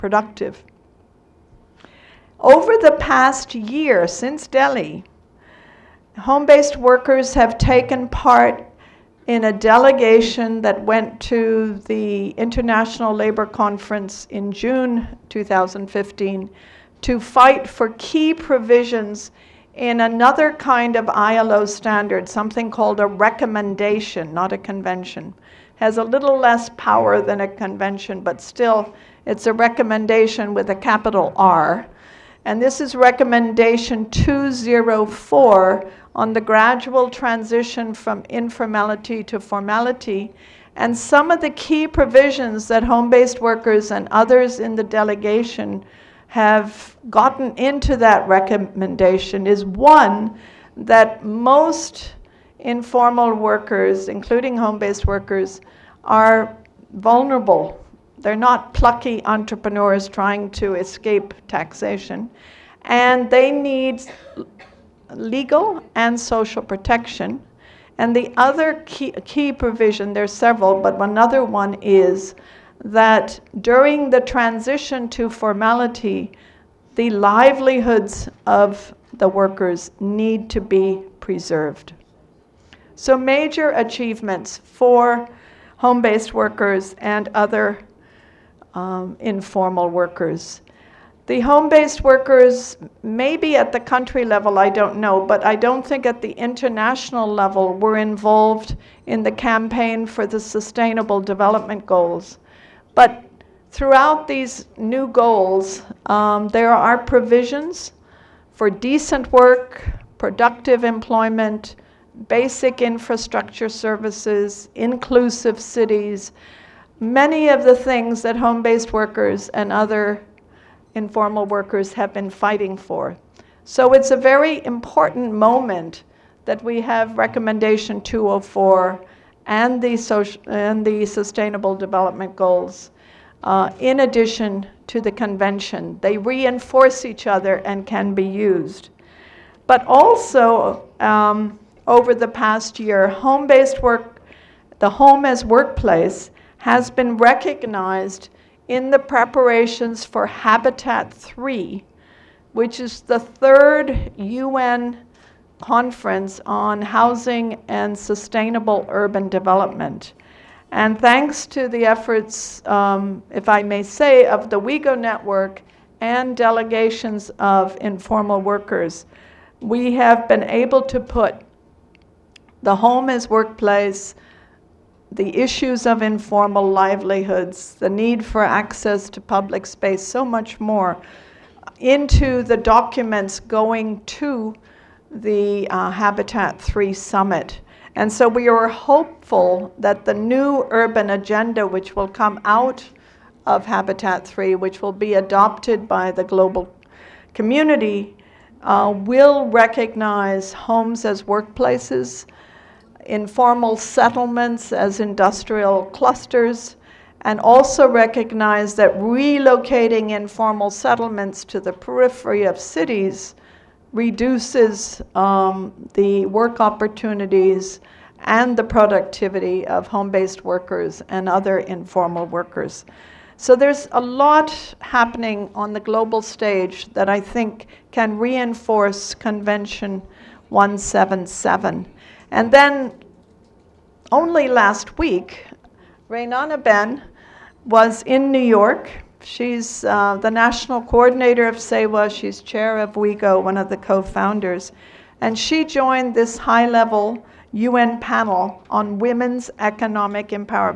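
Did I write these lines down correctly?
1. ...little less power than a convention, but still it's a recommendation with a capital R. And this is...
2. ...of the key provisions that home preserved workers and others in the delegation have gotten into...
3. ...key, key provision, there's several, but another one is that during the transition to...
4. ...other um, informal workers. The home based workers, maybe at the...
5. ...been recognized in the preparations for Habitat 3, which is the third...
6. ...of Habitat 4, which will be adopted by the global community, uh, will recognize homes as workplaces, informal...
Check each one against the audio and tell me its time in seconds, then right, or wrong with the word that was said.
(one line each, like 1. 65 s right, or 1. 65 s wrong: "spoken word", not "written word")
1. 26 s right
2. 41 s wrong: "based", not "preserved"
3. 68 s right
4. 87 s right
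5. 146 s right
6. 193 s wrong: "3", not "4".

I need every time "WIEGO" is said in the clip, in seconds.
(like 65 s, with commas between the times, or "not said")
164 s, 242 s.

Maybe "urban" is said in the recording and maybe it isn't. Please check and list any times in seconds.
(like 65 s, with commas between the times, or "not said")
158 s, 190 s.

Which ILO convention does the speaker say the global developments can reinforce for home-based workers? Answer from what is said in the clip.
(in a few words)
Convention 177.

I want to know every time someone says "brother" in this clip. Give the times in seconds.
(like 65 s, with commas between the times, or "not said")
not said.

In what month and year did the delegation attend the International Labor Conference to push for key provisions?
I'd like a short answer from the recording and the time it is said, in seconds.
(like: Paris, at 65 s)
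June 2015, at 14 s.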